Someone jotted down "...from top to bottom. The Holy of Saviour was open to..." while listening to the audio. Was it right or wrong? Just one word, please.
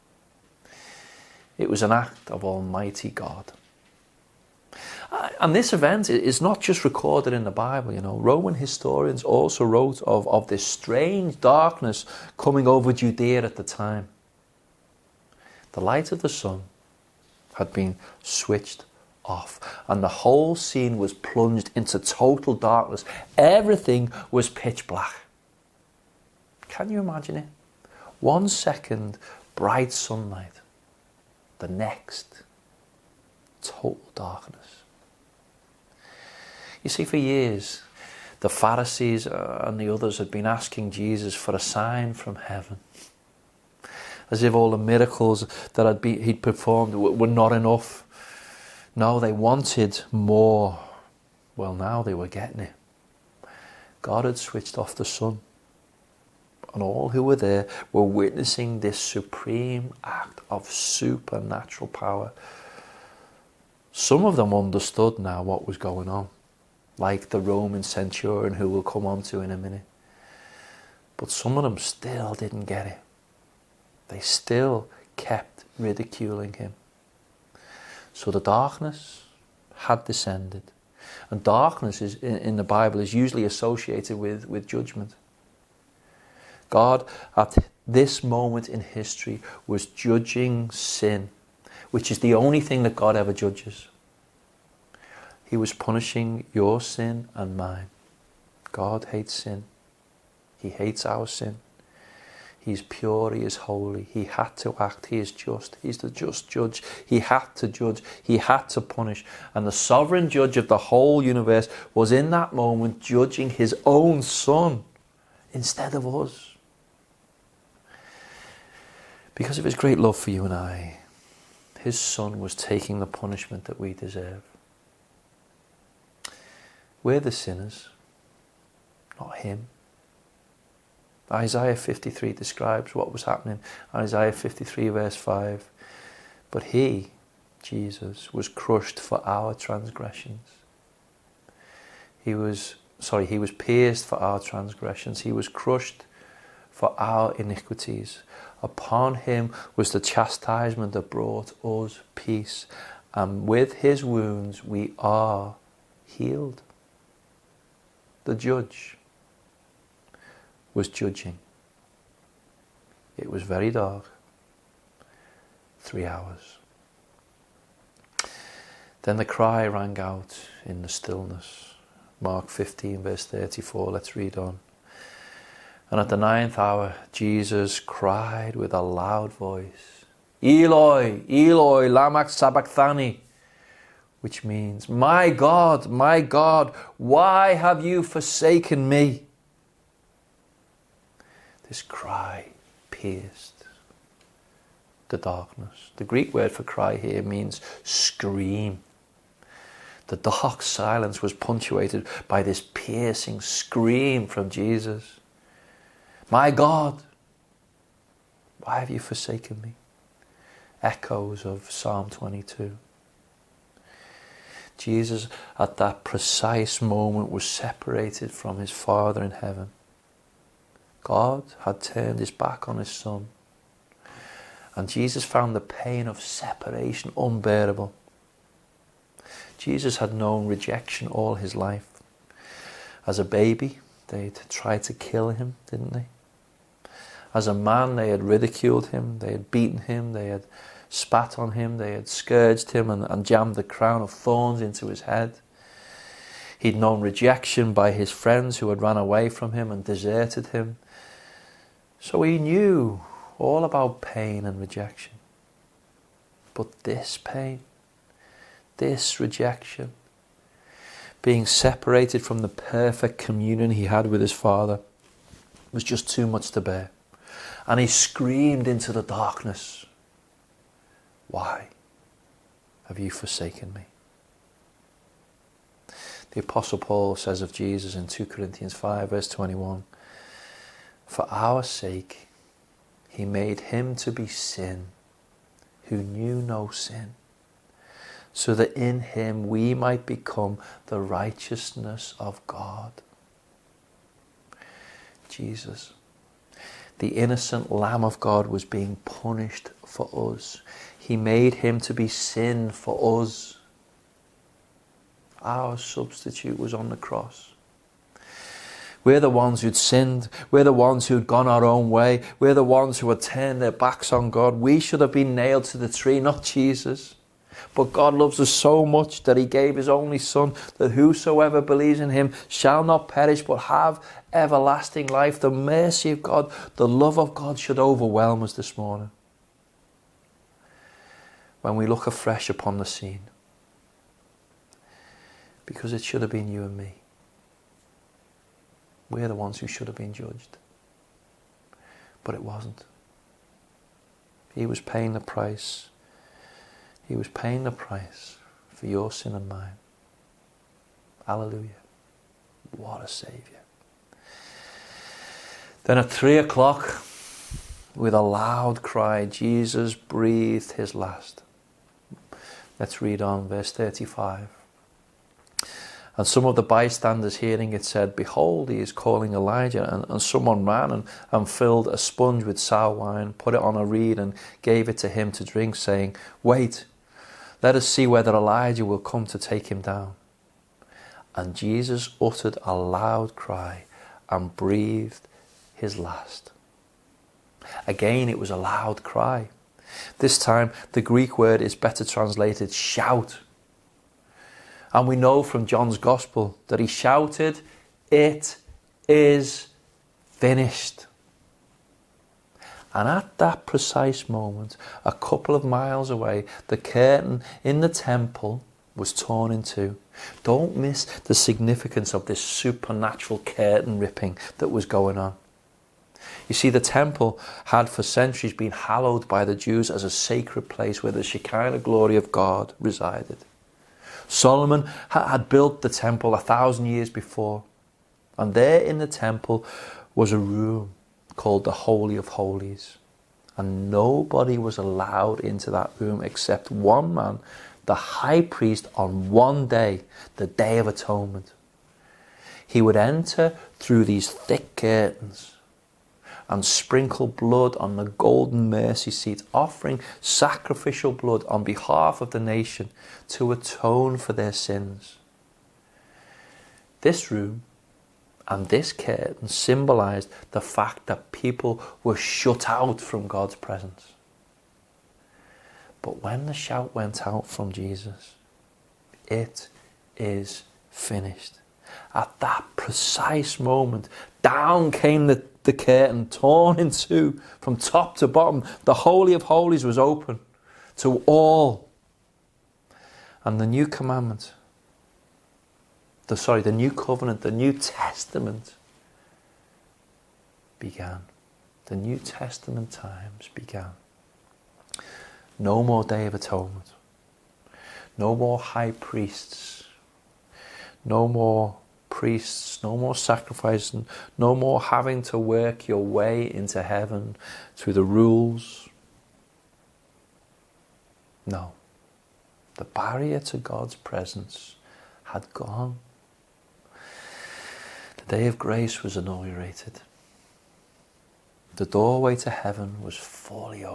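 wrong.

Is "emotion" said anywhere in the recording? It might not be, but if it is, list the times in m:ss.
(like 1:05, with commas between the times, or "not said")
not said.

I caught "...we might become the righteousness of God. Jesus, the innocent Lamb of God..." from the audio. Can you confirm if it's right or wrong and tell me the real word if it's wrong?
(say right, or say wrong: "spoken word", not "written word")
right.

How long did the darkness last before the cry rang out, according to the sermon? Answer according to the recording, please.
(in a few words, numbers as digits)
3 hours.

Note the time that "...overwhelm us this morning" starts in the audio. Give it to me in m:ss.
5:27.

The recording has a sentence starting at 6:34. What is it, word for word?
And we know from John's Gospel that he shouted, It is finished.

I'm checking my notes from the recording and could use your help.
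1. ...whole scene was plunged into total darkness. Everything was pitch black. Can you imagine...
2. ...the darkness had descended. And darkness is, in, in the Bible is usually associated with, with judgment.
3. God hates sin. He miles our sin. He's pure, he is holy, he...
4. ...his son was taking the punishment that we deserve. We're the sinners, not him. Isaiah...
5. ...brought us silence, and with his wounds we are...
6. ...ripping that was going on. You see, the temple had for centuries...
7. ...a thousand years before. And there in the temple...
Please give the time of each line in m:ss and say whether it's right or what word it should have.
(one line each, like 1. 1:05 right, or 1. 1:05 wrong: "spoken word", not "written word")
1. 0:20 right
2. 1:18 right
3. 1:38 wrong: "hates", not "miles"
4. 2:01 right
5. 2:31 wrong: "peace", not "silence"
6. 6:53 right
7. 7:06 right.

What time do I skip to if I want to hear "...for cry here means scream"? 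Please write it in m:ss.
3:16.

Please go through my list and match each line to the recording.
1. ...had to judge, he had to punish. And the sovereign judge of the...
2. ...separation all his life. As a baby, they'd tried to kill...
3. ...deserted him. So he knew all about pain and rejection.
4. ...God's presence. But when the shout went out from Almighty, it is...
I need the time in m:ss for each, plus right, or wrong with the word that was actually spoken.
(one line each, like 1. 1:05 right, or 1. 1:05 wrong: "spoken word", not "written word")
1. 1:47 right
2. 3:50 wrong: "rejection", not "separation"
3. 4:09 right
4. 7:43 wrong: "Jesus", not "Almighty".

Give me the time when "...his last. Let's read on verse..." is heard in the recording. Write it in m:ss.
6:00.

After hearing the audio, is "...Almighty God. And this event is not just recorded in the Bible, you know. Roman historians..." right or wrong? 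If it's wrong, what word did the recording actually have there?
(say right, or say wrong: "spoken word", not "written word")
right.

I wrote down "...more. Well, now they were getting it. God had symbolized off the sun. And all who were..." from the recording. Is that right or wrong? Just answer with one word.
wrong.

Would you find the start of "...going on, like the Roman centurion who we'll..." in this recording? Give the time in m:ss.
1:05.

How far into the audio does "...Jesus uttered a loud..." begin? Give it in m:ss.
6:21.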